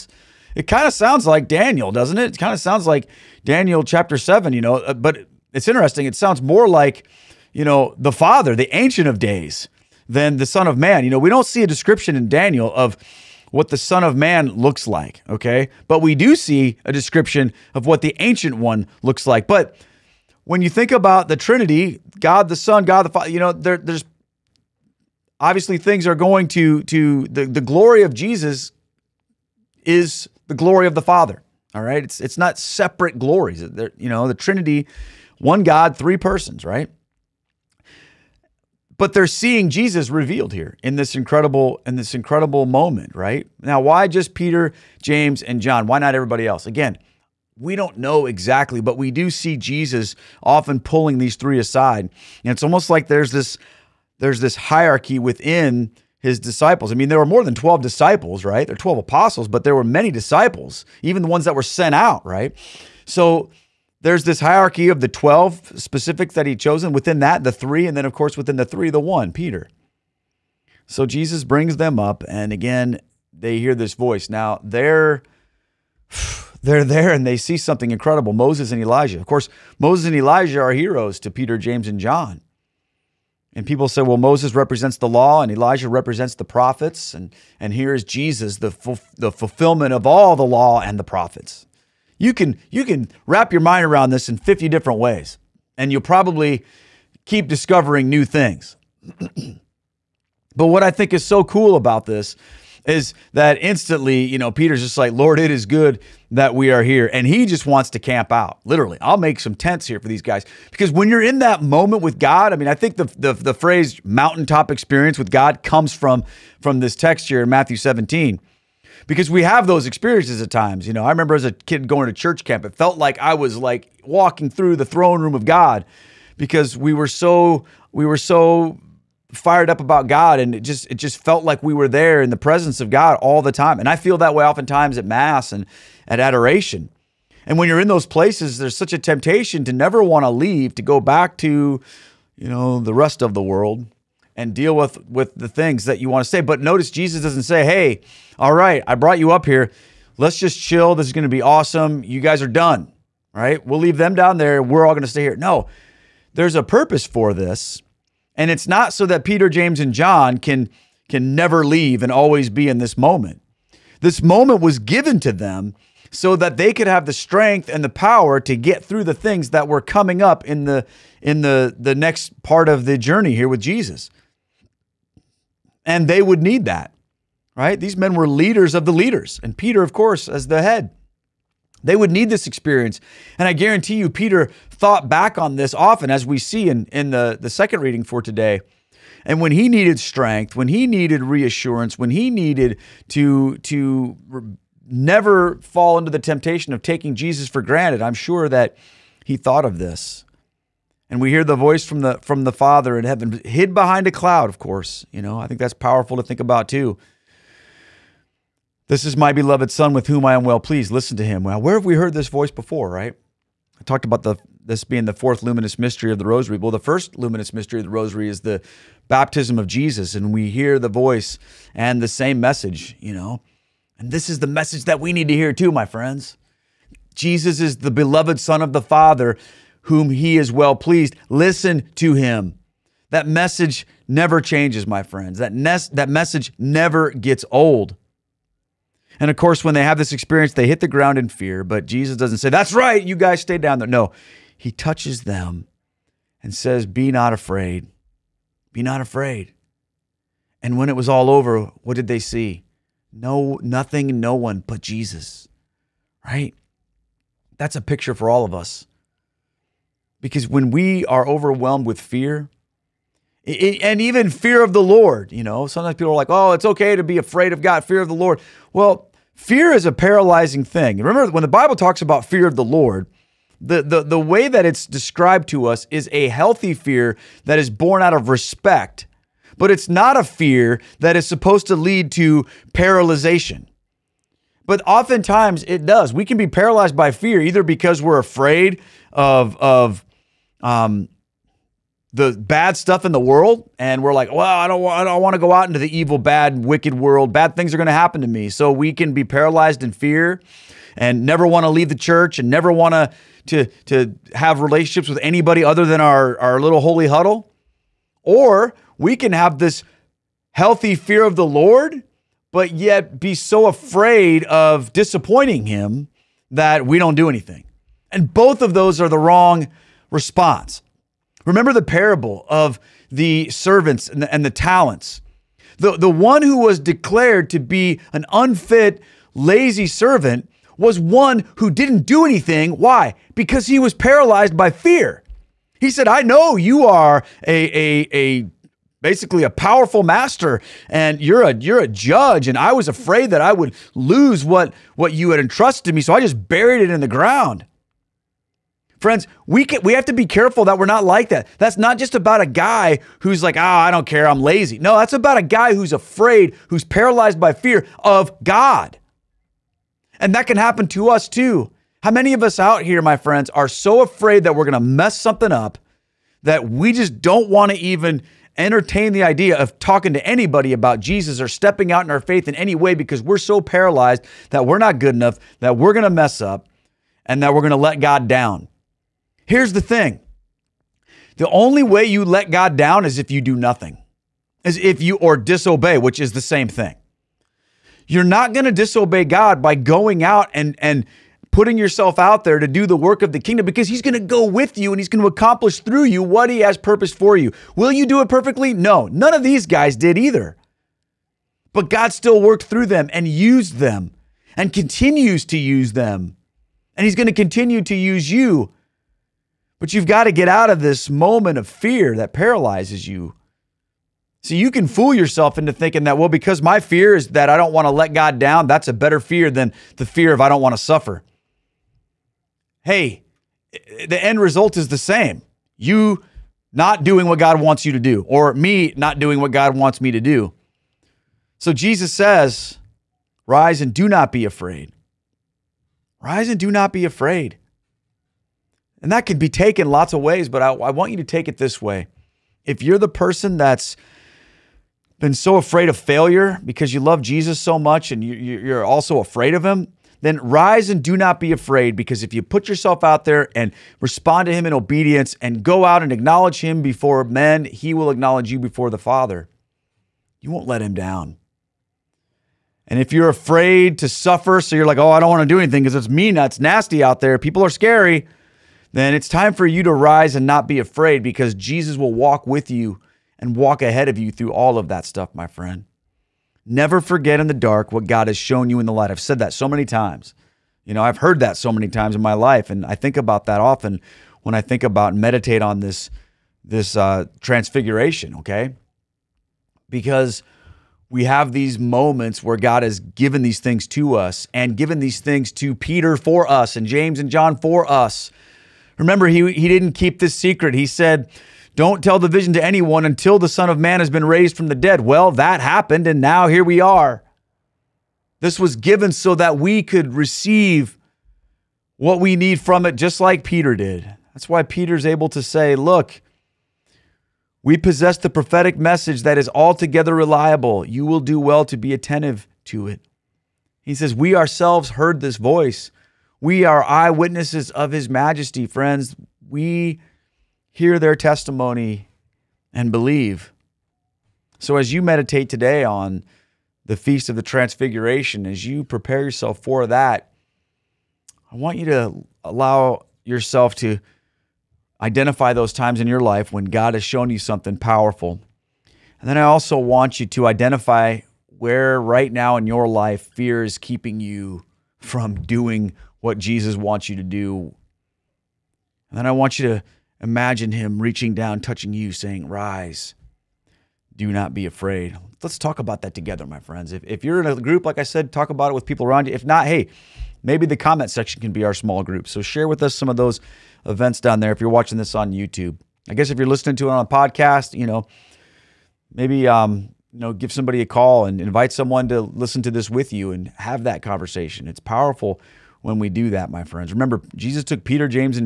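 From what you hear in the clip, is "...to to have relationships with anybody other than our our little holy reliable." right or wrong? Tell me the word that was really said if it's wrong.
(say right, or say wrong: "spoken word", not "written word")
wrong: "huddle", not "reliable".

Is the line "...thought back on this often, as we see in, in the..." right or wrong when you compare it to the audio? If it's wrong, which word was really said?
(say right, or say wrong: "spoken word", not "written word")
right.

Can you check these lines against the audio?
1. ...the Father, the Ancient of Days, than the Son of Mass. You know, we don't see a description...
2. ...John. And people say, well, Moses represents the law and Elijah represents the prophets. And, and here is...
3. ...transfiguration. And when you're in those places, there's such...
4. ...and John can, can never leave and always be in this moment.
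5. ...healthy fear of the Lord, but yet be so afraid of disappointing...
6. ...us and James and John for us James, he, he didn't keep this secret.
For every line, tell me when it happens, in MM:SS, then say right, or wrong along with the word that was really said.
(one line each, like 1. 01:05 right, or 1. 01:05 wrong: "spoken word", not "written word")
1. 00:07 wrong: "Man", not "Mass"
2. 01:22 right
3. 02:16 wrong: "adoration", not "transfiguration"
4. 02:39 right
5. 05:10 right
6. 08:16 wrong: "Remember", not "James".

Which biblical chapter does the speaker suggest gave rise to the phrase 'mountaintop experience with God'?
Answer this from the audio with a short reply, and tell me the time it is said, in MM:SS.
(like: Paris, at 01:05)
Matthew 17, at 01:57.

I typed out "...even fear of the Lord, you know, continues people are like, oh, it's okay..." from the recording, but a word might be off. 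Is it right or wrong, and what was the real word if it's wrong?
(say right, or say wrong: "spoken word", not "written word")
wrong: "sometimes", not "continues".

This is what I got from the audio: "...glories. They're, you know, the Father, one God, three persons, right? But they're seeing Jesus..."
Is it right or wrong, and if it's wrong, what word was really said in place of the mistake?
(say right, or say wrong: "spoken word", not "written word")
wrong: "Trinity", not "Father".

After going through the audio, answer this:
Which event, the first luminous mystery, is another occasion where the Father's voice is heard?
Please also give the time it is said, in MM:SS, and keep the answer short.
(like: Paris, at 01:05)
Baptism of Jesus, at 03:39.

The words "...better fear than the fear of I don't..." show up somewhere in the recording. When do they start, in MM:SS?
06:58.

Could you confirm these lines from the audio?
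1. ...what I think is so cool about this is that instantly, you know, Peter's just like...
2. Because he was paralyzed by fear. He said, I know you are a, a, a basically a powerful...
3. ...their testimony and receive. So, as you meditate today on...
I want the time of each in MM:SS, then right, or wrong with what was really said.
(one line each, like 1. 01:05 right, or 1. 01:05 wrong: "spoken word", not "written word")
1. 01:40 right
2. 05:33 right
3. 08:50 wrong: "believe", not "receive".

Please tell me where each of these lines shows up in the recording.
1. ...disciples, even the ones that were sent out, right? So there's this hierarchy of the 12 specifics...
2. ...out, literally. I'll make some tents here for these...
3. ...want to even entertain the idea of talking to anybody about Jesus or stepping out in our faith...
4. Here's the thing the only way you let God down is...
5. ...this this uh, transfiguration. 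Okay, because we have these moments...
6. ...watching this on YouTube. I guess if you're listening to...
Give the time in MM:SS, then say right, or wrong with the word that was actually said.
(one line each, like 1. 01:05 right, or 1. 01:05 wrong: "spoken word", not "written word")
1. 01:00 right
2. 01:48 right
3. 06:07 right
4. 06:19 right
5. 08:05 right
6. 09:34 right.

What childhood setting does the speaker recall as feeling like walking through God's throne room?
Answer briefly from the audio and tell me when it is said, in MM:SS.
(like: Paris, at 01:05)
Church camp, at 02:02.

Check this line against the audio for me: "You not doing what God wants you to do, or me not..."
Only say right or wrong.
right.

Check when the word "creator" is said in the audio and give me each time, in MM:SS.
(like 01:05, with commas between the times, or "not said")
not said.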